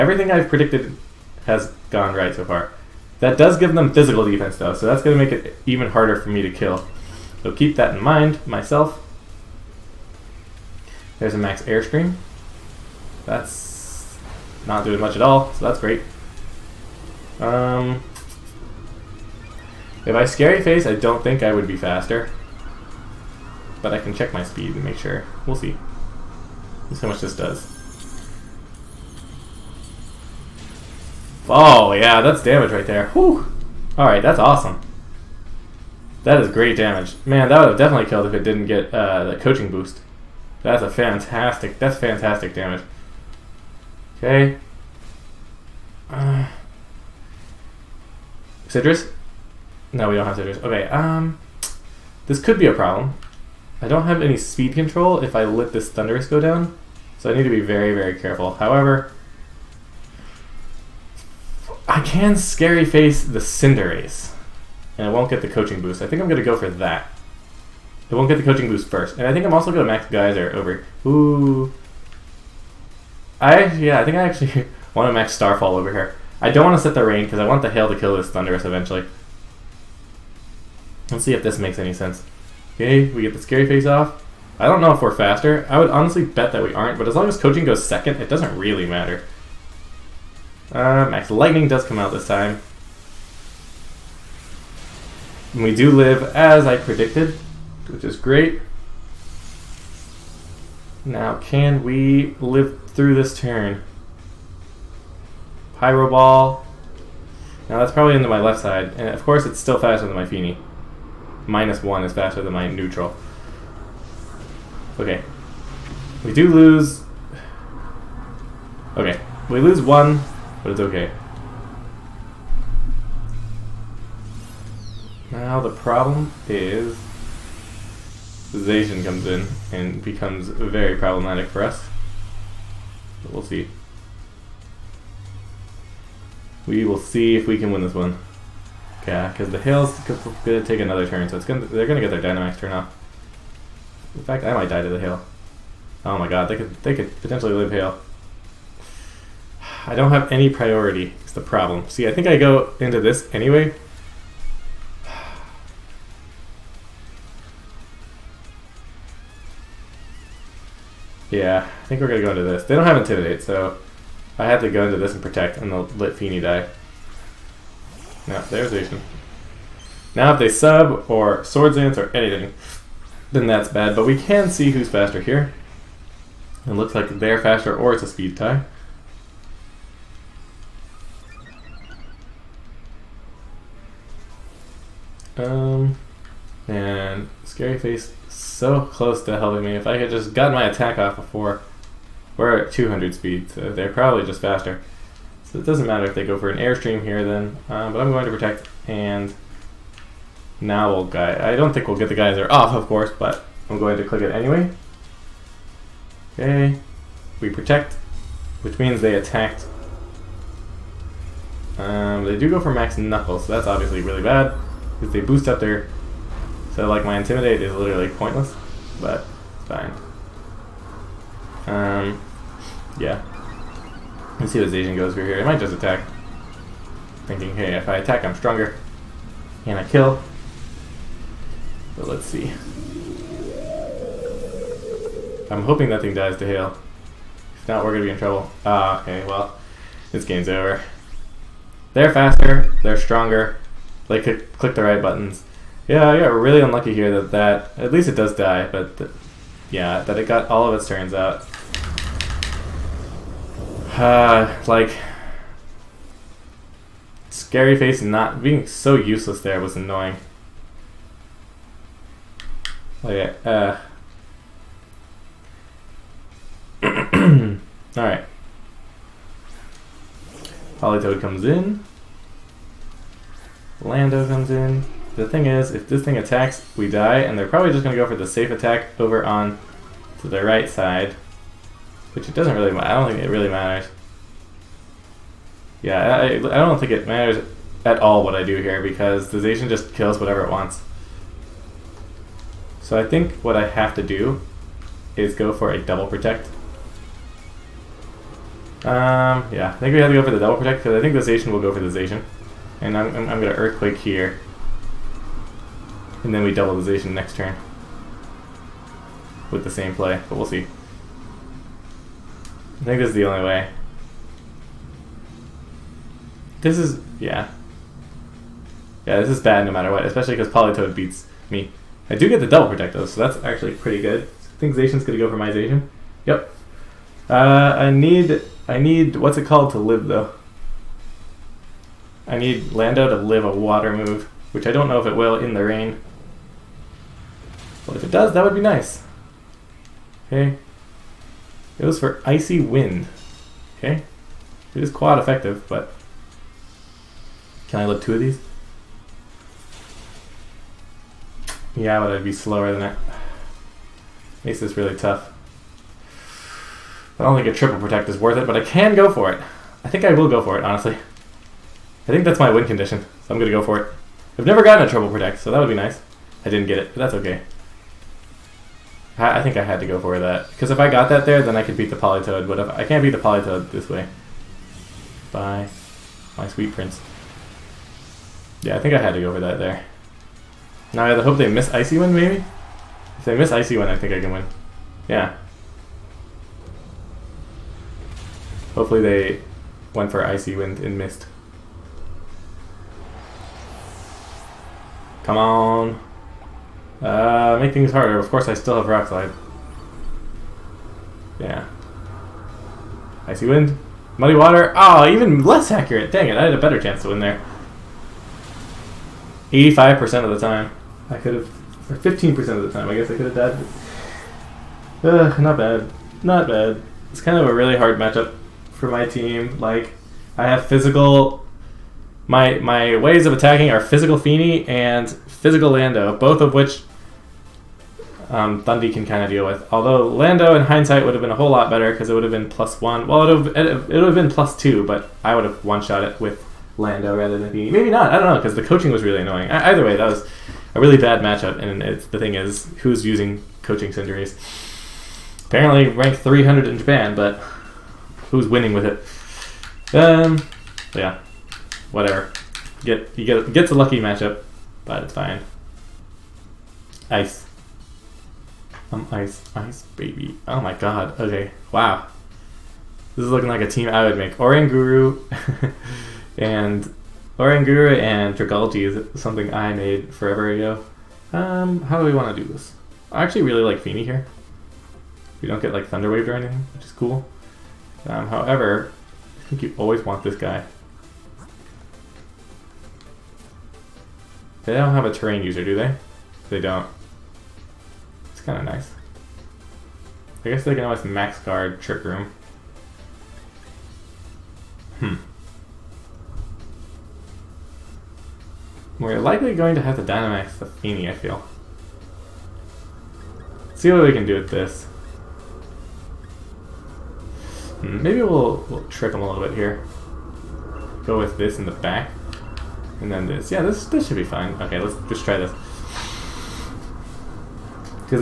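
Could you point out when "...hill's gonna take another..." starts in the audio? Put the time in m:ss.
2:19.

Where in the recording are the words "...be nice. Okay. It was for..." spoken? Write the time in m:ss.
5:38.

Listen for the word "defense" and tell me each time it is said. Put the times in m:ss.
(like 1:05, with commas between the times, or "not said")
0:04.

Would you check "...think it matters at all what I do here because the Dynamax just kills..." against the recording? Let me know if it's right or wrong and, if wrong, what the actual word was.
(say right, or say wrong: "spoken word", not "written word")
wrong: "Zacian", not "Dynamax".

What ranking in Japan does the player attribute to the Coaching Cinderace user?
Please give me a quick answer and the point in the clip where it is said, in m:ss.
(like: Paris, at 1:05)
300, at 7:25.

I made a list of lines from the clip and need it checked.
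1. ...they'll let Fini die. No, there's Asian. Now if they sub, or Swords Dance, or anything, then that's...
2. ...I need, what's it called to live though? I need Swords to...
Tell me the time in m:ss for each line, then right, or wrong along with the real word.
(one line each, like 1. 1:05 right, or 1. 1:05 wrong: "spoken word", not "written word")
1. 2:45 right
2. 5:28 wrong: "Lando", not "Swords".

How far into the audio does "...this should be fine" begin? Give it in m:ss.
8:33.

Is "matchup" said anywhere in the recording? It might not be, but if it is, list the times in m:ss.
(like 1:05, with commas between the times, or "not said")
6:57, 7:21, 7:33.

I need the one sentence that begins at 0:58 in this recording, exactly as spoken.
However, I can Scary Face the Cinderace.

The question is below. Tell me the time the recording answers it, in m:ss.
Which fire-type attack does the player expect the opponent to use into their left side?
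1:45.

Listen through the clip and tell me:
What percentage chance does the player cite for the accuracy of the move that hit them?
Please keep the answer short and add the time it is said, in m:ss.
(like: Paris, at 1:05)
85%, at 6:49.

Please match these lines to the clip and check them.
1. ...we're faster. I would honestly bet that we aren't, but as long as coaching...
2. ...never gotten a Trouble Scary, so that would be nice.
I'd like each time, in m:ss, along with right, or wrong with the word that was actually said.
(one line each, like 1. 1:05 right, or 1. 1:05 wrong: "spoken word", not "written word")
1. 1:25 right
2. 6:04 wrong: "Protect", not "Scary".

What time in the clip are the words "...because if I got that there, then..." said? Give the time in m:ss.
6:10.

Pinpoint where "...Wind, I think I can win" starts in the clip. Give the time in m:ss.
6:23.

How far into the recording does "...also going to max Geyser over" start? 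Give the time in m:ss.
1:09.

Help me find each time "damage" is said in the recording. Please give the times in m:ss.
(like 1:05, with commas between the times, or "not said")
0:32, 0:36, 0:42.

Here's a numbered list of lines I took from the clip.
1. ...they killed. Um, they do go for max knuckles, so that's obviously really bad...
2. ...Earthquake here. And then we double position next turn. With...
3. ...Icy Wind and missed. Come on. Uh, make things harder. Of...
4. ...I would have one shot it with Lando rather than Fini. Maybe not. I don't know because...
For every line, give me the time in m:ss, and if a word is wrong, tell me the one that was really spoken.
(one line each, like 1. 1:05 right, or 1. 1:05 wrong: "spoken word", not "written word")
1. 3:29 wrong: "attacked", not "killed"
2. 5:03 right
3. 6:30 right
4. 7:15 right.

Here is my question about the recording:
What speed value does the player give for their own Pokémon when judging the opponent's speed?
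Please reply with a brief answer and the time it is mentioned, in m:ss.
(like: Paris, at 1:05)
200, at 3:12.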